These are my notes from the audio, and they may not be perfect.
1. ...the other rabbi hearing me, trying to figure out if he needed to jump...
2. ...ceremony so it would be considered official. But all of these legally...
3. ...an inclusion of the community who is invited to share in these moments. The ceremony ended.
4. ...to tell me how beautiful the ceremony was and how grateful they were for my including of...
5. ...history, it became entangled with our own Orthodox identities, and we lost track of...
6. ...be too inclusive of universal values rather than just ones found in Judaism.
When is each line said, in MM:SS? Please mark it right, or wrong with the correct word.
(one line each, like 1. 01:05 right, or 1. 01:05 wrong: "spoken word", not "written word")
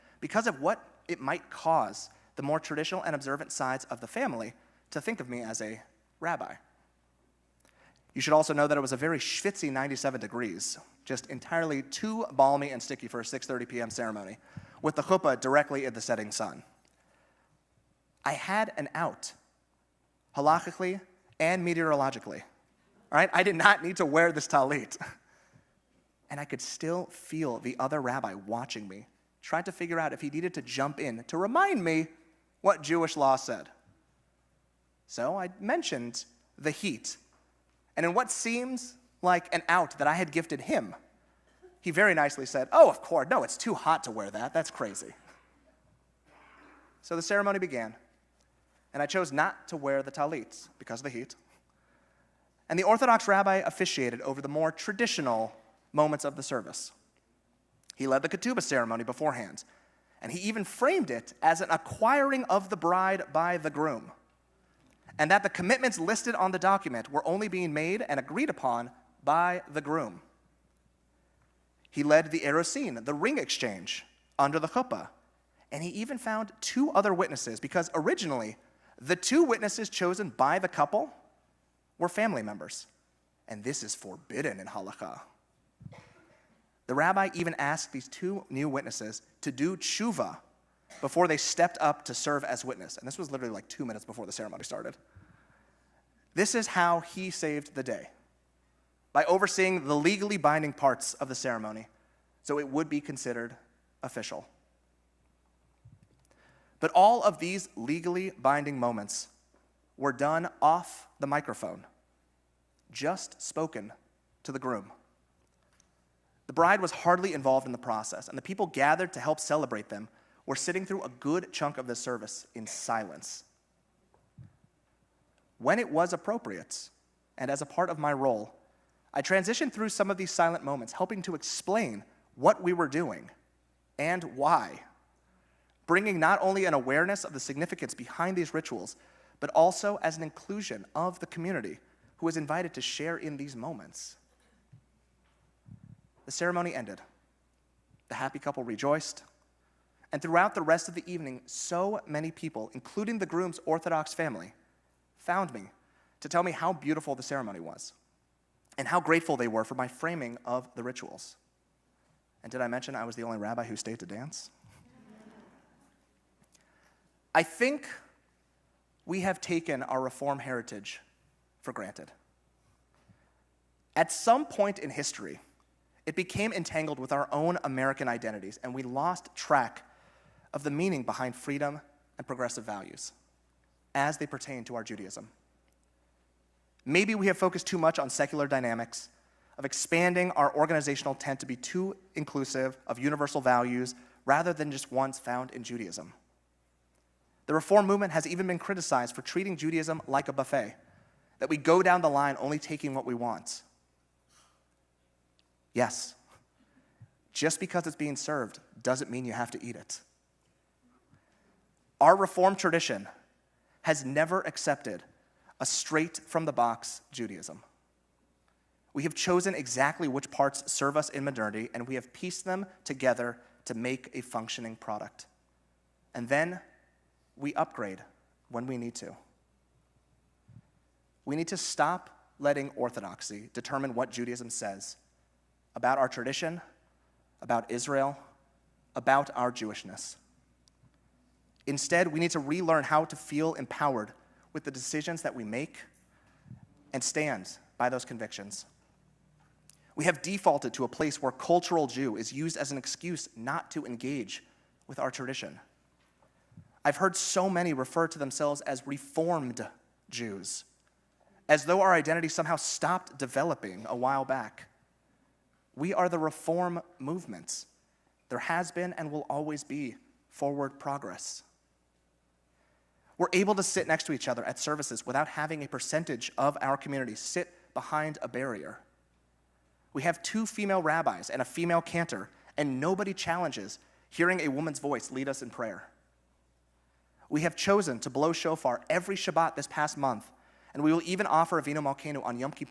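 1. 00:27 wrong: "watching", not "hearing"
2. 01:41 right
3. 02:20 right
4. 02:36 wrong: "framing", not "including"
5. 02:54 wrong: "American", not "Orthodox"
6. 03:11 right.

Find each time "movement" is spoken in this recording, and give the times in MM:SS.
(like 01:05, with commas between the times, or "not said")
03:17, 04:26.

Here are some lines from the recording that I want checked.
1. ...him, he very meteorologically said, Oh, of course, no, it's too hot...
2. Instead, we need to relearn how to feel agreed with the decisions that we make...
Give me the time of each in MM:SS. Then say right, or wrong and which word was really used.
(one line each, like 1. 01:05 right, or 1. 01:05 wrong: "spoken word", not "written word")
1. 00:40 wrong: "nicely", not "meteorologically"
2. 04:01 wrong: "empowered", not "agreed".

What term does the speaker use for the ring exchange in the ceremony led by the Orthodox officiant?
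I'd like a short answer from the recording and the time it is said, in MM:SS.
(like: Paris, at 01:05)
erusin, at 01:12.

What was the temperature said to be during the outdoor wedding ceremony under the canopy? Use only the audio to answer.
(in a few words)
97 degrees.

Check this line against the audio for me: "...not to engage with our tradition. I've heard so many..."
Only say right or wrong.
right.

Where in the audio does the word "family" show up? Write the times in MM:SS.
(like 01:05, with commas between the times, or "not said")
00:04, 01:22, 02:34.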